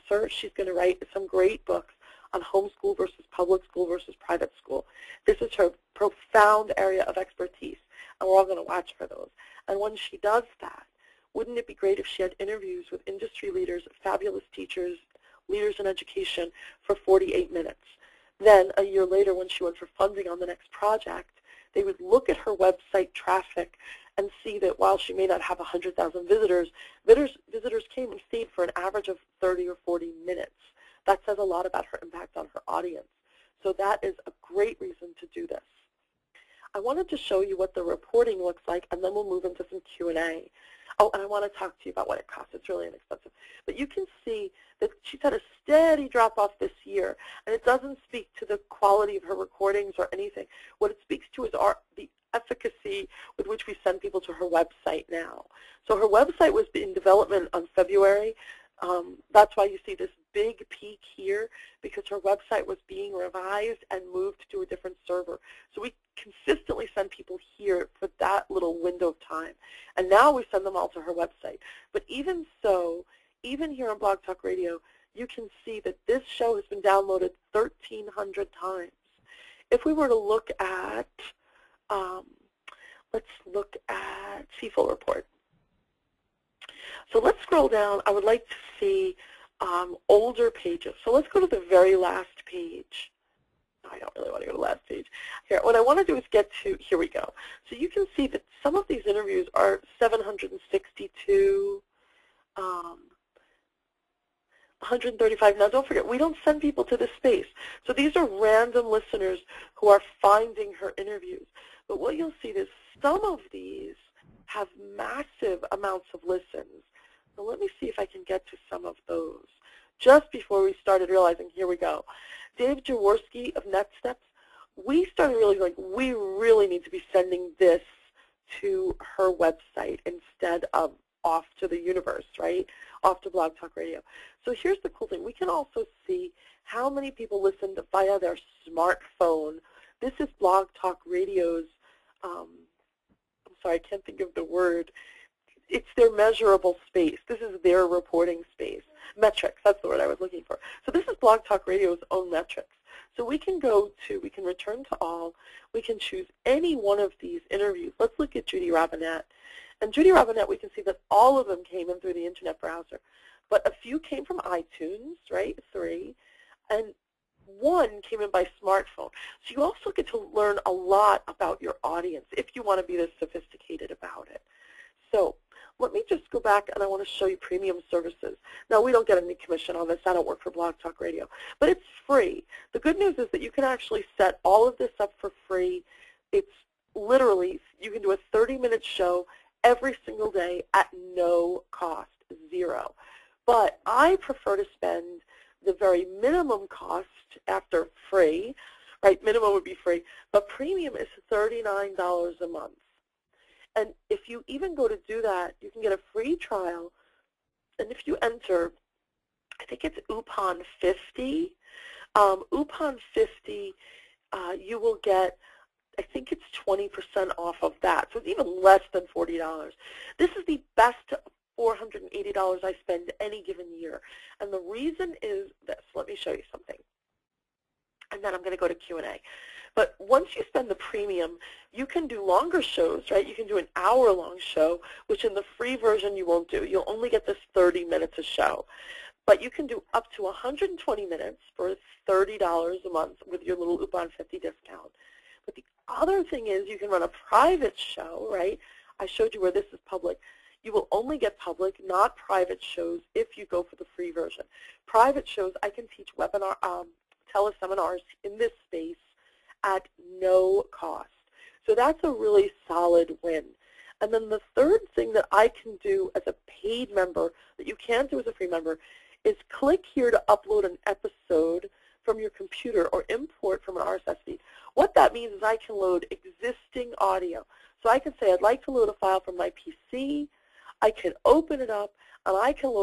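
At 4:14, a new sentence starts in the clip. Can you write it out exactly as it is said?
Private shows, I can teach webinar, um, teleseminars in this space at no cost.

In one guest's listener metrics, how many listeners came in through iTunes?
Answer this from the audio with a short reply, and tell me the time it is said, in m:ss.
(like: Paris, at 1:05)
3, at 2:45.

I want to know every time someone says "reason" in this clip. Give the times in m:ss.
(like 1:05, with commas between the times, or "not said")
0:34, 3:44.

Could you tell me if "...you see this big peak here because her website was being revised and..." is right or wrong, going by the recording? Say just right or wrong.
right.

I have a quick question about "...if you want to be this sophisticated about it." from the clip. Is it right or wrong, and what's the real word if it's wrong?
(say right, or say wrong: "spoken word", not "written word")
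right.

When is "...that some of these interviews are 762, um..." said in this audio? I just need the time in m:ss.
1:38.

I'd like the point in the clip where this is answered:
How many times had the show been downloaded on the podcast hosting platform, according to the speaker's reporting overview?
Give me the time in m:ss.
1:17.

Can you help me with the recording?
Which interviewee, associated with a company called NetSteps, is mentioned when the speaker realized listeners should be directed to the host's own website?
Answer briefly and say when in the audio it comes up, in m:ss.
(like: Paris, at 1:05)
Dave Jaworski, at 2:02.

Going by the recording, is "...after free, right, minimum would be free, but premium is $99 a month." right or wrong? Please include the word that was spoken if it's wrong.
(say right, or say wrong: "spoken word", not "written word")
wrong: "39", not "99".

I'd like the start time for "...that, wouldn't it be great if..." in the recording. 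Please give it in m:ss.
0:10.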